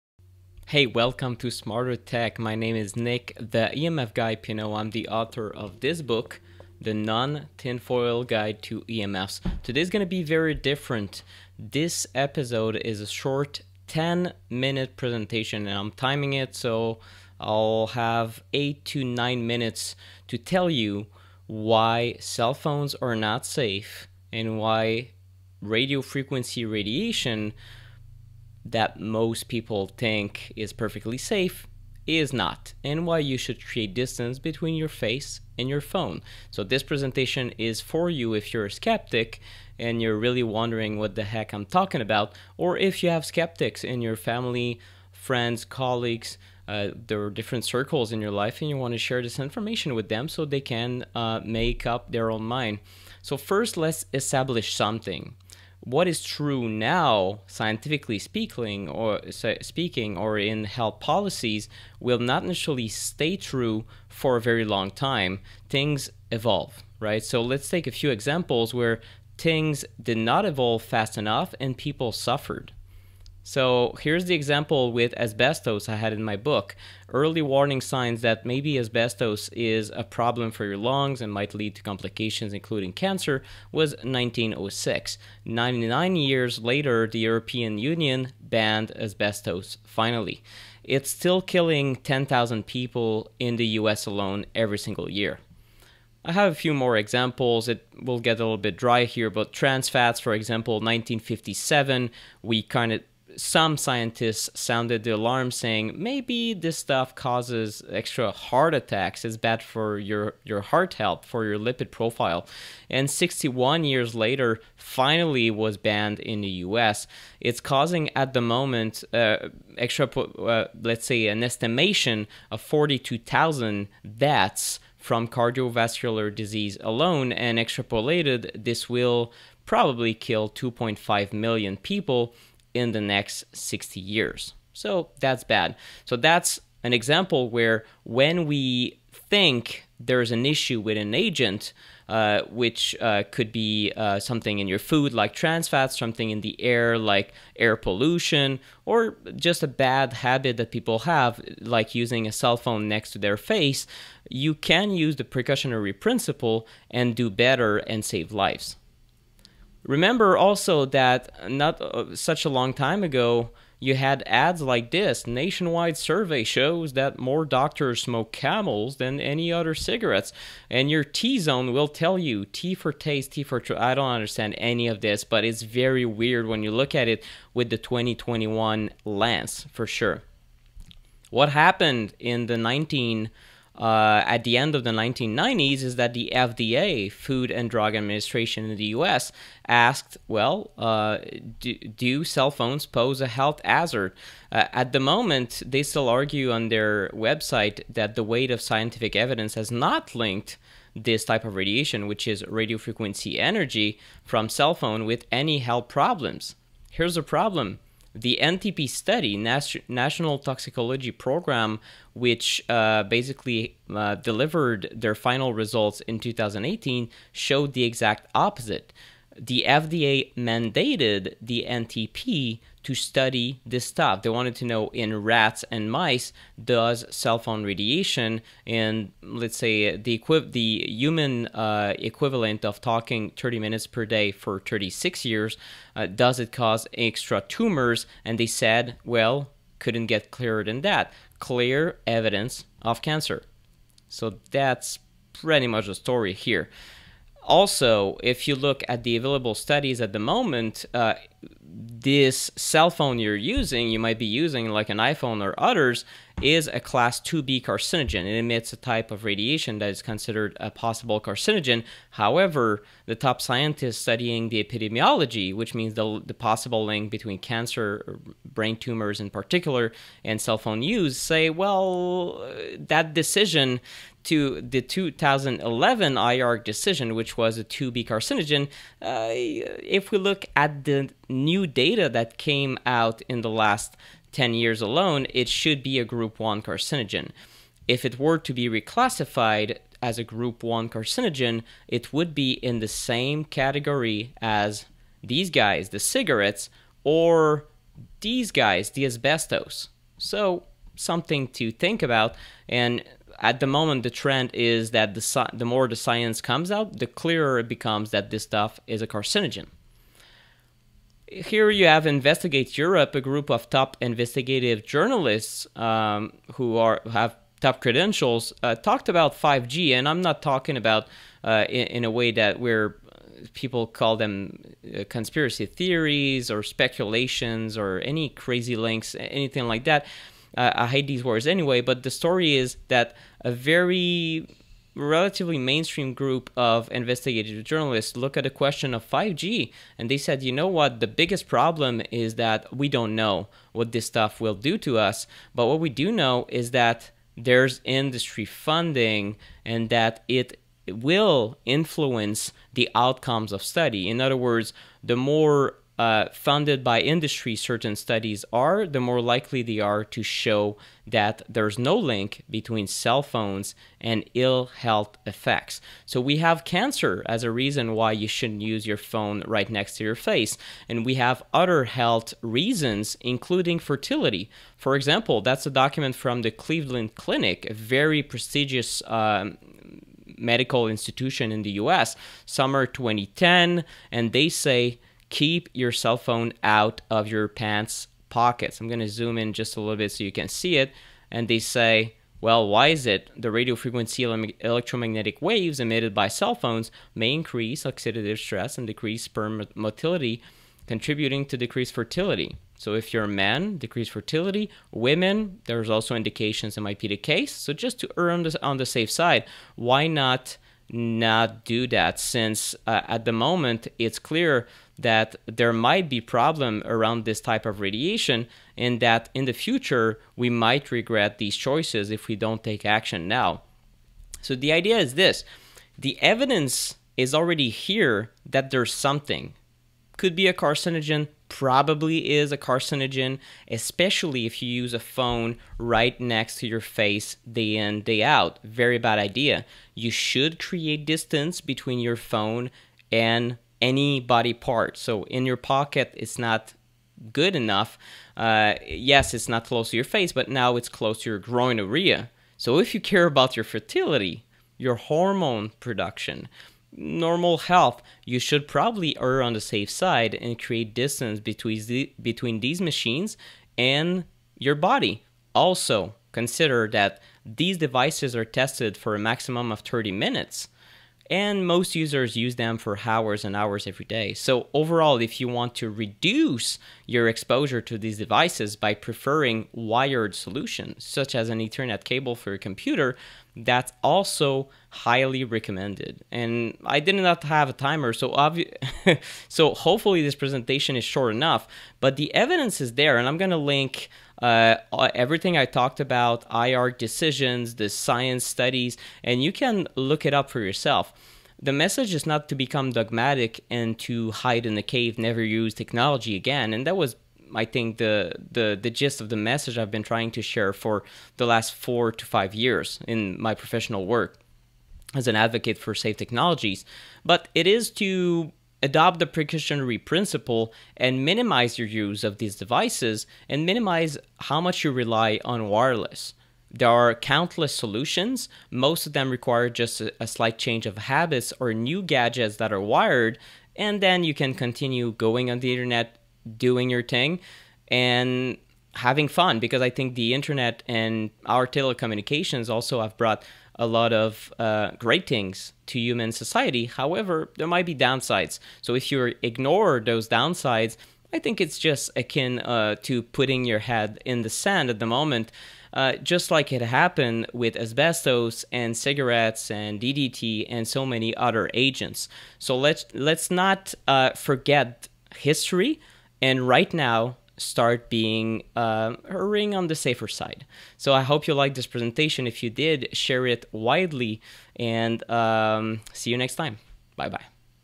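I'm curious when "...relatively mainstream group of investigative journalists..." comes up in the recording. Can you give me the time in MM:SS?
05:34.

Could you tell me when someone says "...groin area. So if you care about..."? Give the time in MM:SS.
07:31.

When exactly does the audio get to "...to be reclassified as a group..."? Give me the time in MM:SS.
04:48.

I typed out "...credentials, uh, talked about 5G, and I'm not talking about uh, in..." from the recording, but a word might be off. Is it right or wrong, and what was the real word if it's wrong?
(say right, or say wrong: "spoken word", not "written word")
right.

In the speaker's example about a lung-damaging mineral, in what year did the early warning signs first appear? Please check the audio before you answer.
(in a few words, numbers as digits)
1906.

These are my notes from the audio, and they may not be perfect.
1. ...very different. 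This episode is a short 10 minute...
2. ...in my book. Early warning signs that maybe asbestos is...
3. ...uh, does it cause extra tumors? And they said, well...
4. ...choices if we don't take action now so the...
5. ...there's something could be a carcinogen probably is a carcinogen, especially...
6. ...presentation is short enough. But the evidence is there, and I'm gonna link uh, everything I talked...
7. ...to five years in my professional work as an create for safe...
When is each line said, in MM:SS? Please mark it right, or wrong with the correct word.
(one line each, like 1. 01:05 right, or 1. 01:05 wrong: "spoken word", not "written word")
1. 00:10 right
2. 01:16 right
3. 03:55 right
4. 07:01 right
5. 07:08 right
6. 08:10 right
7. 08:32 wrong: "advocate", not "create".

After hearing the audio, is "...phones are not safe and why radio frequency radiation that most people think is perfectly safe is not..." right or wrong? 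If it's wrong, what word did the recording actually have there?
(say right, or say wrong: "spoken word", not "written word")
right.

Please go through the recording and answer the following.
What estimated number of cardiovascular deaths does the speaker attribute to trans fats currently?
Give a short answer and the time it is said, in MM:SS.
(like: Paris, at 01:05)
42,000, at 02:02.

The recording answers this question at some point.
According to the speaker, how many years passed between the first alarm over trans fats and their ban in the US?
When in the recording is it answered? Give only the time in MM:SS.
01:53.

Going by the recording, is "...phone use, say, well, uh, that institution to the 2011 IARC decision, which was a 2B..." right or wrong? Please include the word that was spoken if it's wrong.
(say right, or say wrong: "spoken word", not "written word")
wrong: "decision", not "institution".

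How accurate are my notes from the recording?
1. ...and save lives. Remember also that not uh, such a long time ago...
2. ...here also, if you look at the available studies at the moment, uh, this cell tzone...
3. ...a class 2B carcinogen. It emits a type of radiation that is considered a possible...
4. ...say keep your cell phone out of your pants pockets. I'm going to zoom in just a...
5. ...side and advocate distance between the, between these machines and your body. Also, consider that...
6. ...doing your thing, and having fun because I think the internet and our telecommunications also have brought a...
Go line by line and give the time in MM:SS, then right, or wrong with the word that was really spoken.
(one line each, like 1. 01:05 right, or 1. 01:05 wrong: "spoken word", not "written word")
1. 02:37 right
2. 04:06 wrong: "phone", not "tzone"
3. 04:16 right
4. 06:24 right
5. 07:39 wrong: "create", not "advocate"
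6. 08:56 right.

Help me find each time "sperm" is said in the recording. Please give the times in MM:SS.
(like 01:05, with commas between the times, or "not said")
06:39.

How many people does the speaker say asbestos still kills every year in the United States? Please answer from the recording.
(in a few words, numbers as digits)
10,000.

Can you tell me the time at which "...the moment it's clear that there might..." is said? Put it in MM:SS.
06:53.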